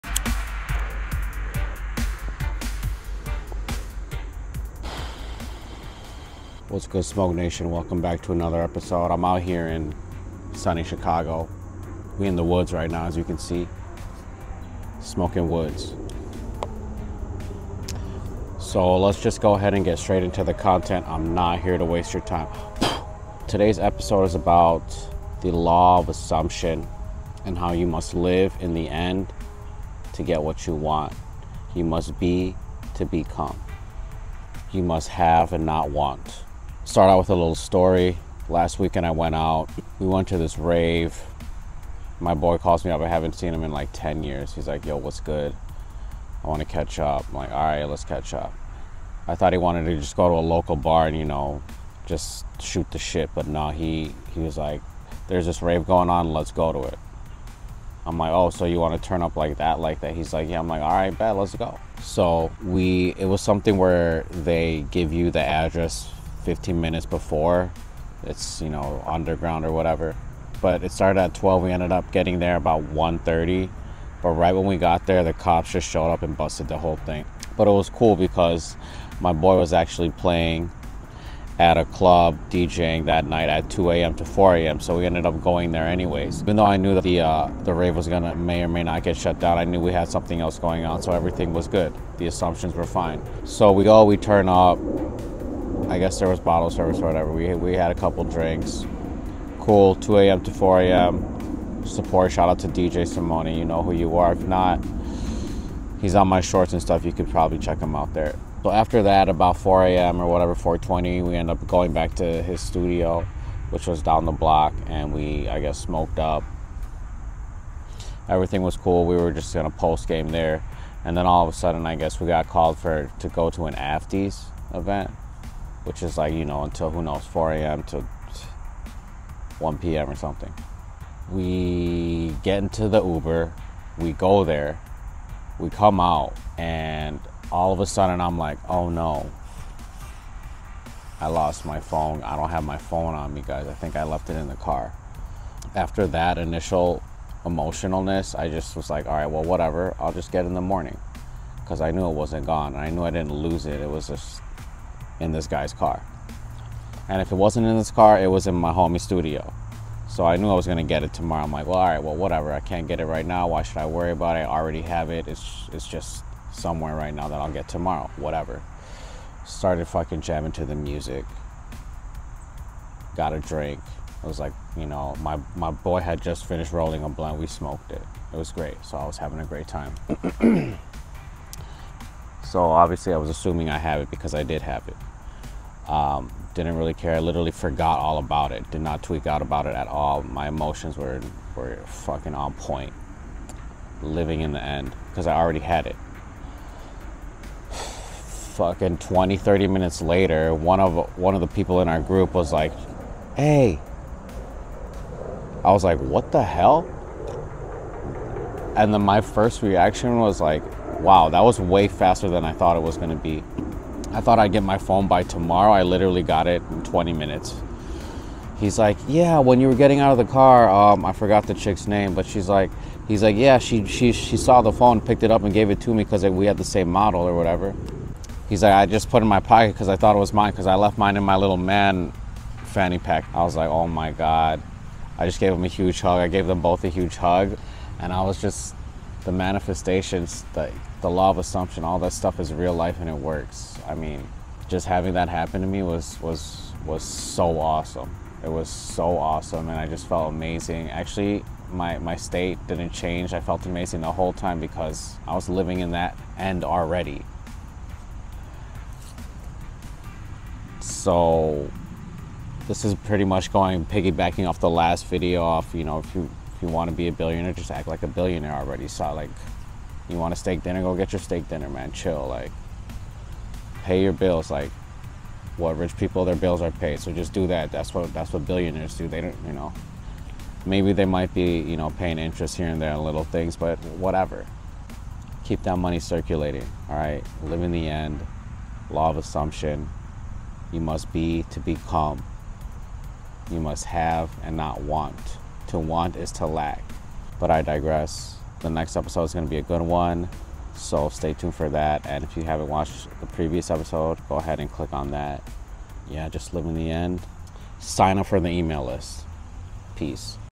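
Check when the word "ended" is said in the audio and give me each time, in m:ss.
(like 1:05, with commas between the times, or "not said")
1:11, 1:25.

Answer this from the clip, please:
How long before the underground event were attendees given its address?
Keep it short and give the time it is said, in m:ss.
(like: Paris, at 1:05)
15 minutes, at 1:06.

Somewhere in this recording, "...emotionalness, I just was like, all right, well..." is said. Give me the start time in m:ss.
2:27.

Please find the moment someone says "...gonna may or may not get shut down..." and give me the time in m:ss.
1:28.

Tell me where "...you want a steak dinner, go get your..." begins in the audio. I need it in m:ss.
4:30.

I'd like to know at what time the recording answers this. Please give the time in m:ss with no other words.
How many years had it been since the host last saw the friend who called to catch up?
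0:43.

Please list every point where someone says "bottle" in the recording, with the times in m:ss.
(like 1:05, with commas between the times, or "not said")
1:36.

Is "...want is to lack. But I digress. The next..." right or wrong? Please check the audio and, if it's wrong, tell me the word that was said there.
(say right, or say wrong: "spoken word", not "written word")
right.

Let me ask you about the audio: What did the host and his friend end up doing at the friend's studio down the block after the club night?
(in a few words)
Smoked up.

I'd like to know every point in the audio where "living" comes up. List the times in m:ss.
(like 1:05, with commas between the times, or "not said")
3:14, 4:15.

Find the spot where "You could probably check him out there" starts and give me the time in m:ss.
1:47.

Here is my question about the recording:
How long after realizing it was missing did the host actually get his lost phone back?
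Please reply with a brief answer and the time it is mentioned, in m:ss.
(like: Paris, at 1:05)
20 minutes, at 3:36.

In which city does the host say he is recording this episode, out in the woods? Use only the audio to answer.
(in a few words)
Chicago.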